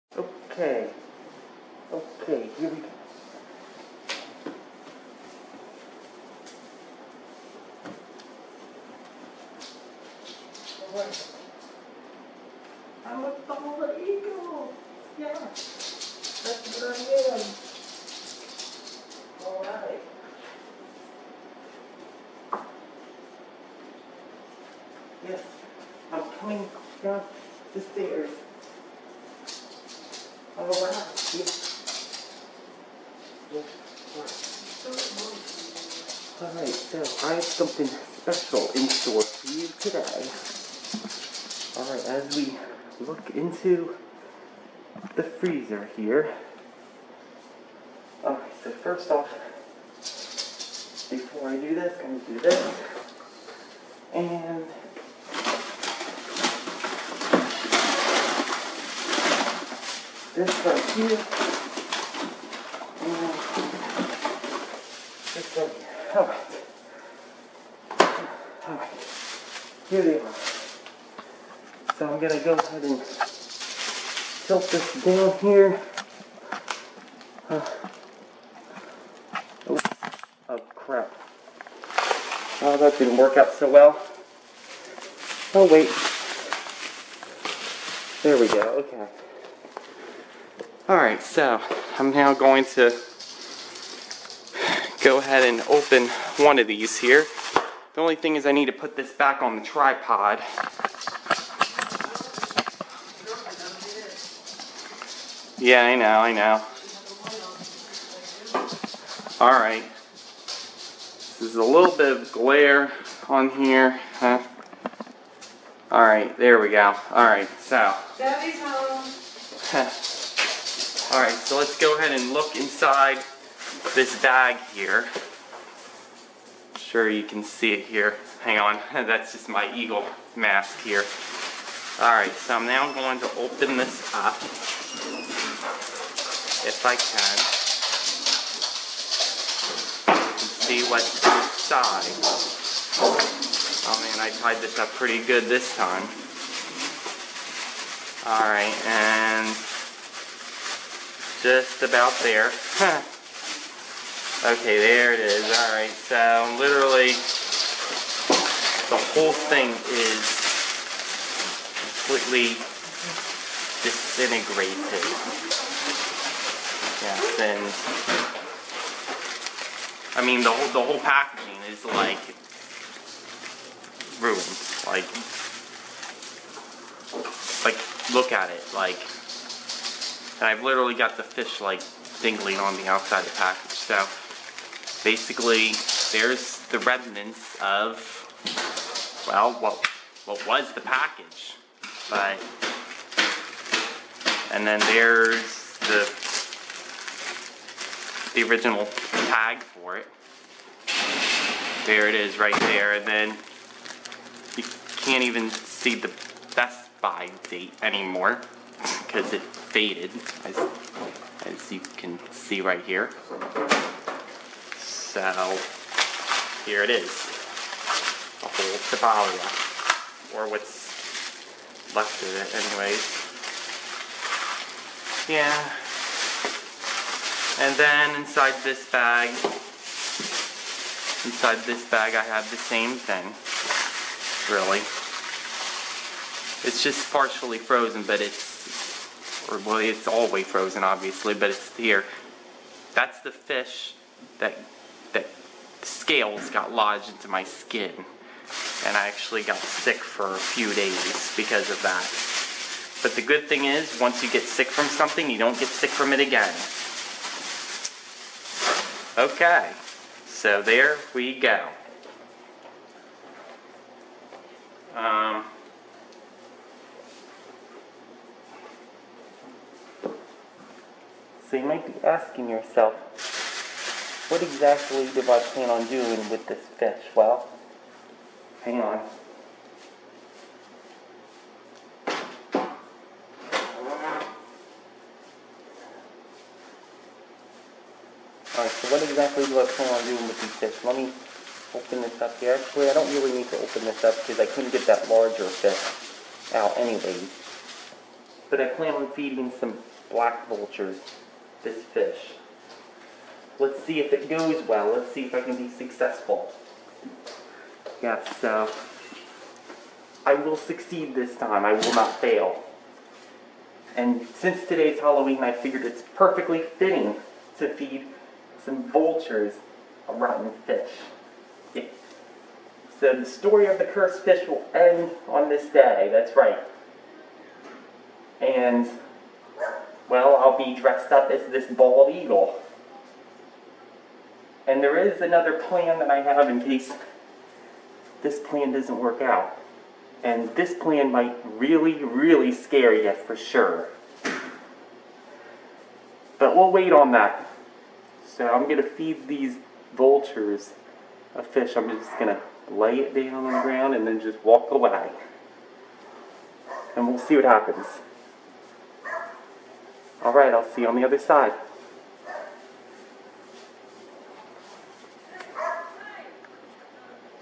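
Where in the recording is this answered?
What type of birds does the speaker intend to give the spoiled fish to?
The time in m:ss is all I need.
5:00.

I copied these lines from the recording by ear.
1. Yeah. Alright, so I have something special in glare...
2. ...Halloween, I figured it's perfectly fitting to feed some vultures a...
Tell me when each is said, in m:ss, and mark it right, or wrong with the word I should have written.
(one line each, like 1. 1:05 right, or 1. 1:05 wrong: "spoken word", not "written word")
1. 0:33 wrong: "store", not "glare"
2. 5:14 right.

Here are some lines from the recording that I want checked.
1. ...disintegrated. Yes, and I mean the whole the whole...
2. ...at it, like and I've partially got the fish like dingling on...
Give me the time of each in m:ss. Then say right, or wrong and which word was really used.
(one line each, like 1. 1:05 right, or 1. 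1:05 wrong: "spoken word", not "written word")
1. 2:43 right
2. 2:58 wrong: "literally", not "partially".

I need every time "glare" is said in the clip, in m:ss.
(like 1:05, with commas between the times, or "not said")
1:52.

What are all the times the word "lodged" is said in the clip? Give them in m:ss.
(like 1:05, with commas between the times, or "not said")
4:06.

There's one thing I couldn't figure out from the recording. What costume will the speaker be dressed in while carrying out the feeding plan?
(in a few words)
bald eagle.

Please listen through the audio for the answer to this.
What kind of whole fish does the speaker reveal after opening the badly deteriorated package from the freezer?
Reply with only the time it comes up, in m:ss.
3:38.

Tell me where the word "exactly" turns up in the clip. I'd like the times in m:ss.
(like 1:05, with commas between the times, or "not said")
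4:34, 4:49.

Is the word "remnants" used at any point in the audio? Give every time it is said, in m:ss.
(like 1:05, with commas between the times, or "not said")
3:06.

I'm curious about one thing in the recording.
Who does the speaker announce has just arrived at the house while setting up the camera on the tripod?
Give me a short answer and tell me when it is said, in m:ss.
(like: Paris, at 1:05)
Debbie, at 1:58.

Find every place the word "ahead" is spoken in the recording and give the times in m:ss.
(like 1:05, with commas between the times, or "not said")
1:12, 1:35, 2:01.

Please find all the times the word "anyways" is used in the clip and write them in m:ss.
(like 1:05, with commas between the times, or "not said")
3:42, 4:56.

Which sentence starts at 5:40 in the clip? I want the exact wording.
And this plan might really, really scare you for sure.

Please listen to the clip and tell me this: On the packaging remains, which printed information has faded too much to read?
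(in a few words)
best by date.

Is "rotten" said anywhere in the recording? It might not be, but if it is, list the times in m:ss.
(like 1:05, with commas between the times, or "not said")
5:20.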